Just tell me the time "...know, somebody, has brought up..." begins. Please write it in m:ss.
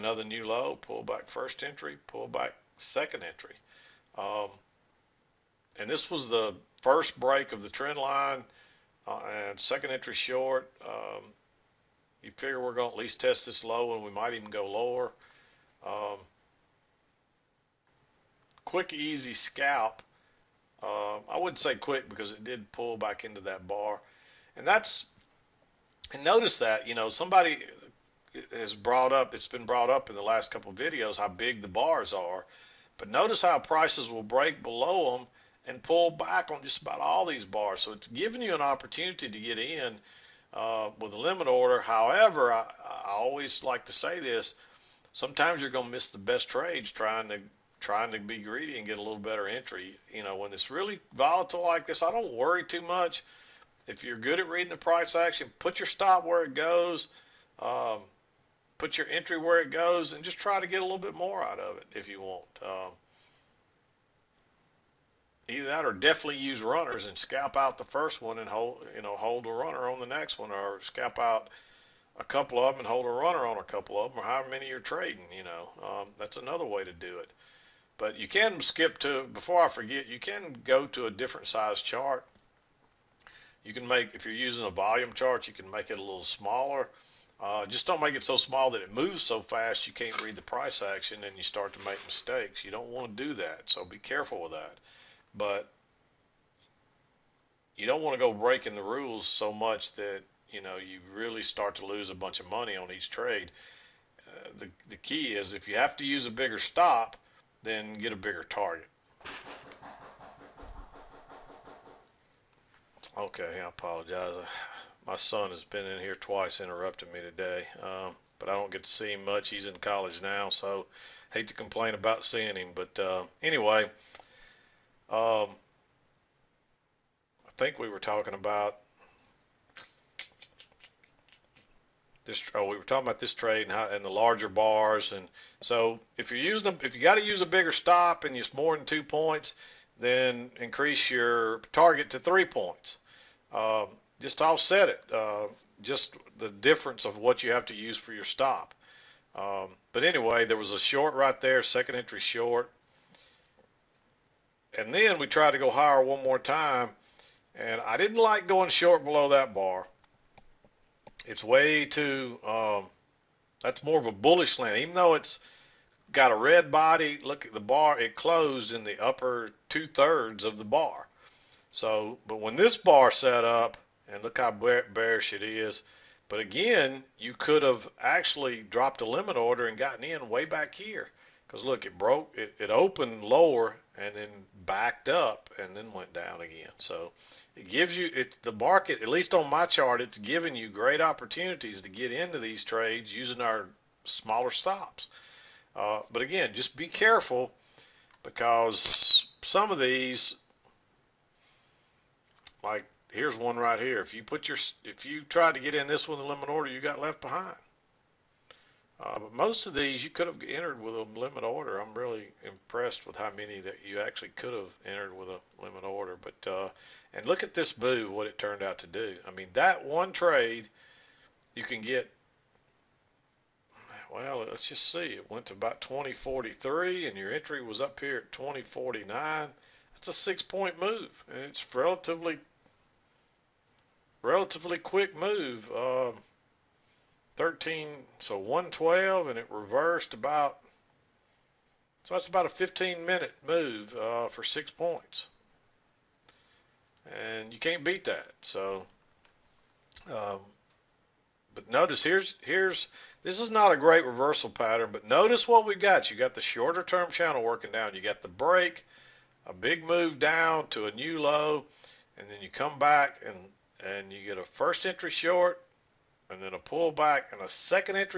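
0:26.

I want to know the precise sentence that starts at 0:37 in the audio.
So it's giving you an opportunity to get in uh, with a limit order.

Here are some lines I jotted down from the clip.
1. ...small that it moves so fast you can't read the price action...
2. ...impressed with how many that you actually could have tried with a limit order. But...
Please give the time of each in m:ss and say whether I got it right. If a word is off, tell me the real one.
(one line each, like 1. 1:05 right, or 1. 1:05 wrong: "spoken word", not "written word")
1. 1:28 right
2. 3:32 wrong: "entered", not "tried".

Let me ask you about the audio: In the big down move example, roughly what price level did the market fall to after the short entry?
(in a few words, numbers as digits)
2043.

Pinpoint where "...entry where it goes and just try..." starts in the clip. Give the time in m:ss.
0:59.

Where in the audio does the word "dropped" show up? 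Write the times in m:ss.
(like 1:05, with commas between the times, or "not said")
2:58.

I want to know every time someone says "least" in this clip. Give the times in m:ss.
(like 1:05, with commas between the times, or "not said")
0:12, 3:09.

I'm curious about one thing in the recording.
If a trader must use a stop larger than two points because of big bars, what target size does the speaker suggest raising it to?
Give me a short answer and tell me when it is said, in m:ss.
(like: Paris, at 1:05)
3 points, at 2:22.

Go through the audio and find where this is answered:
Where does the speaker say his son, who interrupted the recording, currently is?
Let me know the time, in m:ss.
1:59.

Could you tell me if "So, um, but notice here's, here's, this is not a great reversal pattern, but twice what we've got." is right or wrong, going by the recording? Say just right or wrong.
wrong.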